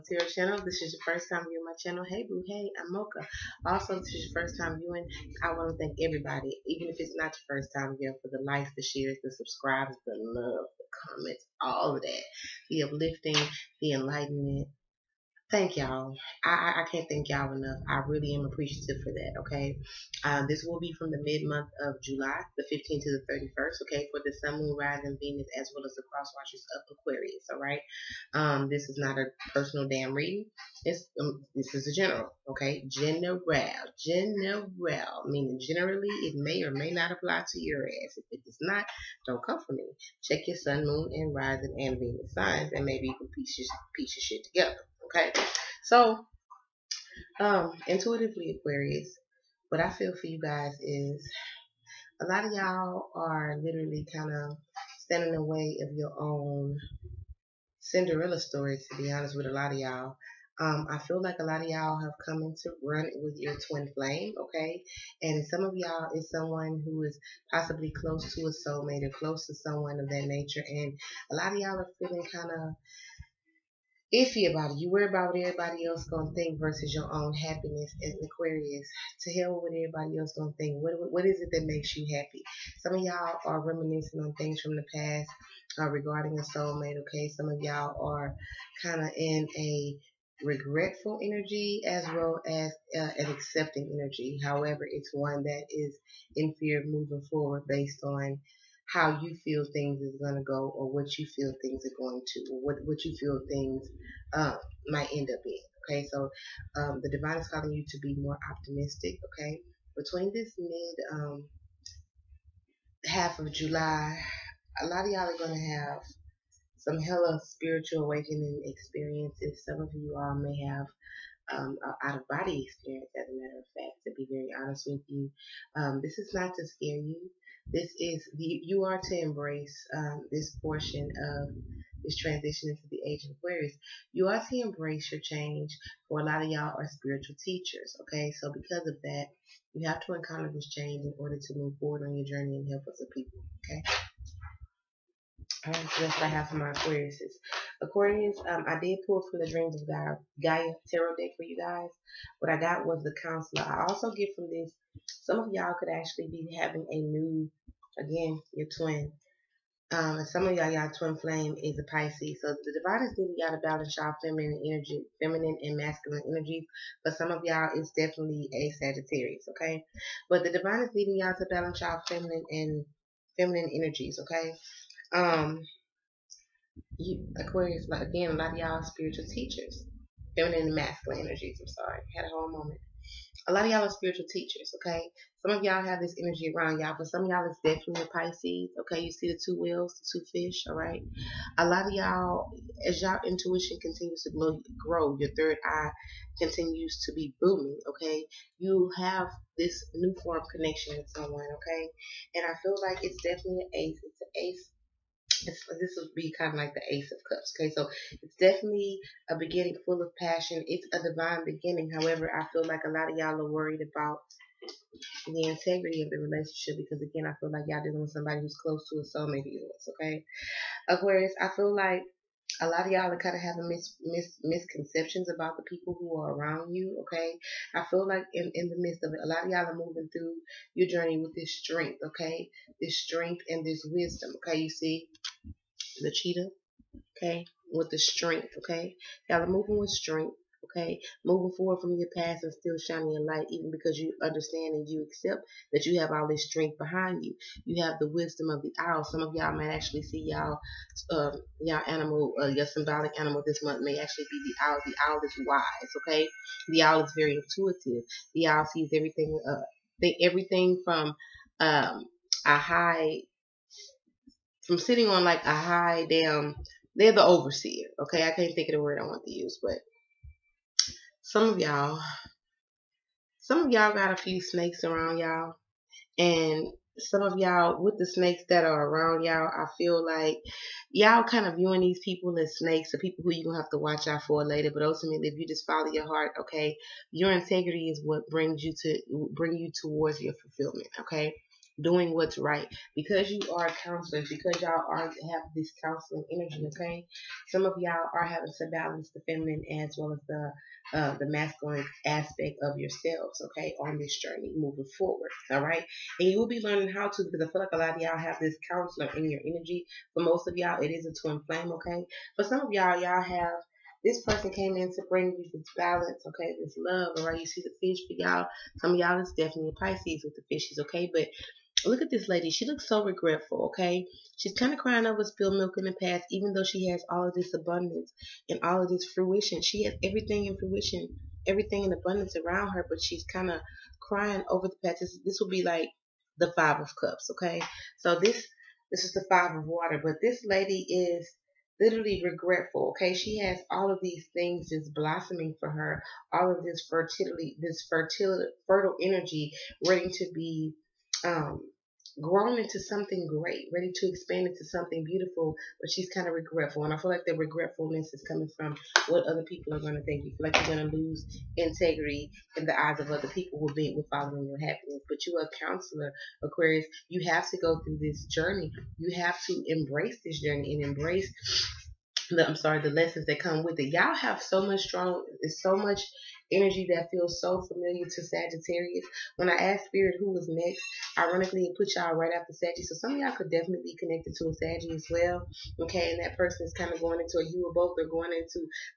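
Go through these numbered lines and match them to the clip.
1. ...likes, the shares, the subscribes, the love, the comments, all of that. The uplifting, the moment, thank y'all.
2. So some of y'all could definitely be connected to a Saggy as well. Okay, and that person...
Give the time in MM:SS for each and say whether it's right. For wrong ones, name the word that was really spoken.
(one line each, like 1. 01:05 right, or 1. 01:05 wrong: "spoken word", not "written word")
1. 00:08 wrong: "enlightenment", not "moment"
2. 06:22 right.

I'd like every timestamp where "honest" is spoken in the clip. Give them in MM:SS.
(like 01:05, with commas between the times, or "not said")
00:59, 02:04.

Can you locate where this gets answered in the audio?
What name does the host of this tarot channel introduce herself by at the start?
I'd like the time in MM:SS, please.
00:02.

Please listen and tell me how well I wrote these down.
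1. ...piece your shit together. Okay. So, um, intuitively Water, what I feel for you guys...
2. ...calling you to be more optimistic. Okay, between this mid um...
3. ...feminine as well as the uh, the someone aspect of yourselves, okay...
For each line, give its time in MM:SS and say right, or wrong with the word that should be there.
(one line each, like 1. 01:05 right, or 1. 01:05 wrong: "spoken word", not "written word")
1. 00:43 wrong: "Aquarius", not "Water"
2. 01:47 right
3. 04:59 wrong: "masculine", not "someone".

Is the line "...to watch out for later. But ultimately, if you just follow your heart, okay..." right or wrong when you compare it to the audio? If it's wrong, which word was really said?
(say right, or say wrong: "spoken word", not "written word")
right.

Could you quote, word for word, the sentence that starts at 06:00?
You feel like you're going to lose integrity in the eyes of other people who be with following your happiness.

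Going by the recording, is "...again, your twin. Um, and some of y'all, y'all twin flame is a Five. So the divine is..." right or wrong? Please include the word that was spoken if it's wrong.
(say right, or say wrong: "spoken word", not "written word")
wrong: "Pisces", not "Five".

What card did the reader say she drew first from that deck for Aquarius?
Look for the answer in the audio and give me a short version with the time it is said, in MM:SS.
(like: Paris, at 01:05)
The Counselor, at 02:33.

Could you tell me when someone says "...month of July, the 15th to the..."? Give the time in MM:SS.
00:21.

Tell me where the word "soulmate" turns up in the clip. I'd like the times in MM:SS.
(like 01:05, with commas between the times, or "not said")
01:08, 01:26, 03:39.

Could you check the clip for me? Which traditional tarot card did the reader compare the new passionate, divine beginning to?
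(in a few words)
Ace of Cups.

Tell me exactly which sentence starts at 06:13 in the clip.
Y'all have so much strong, so much energy that feels so familiar to Sagittarius.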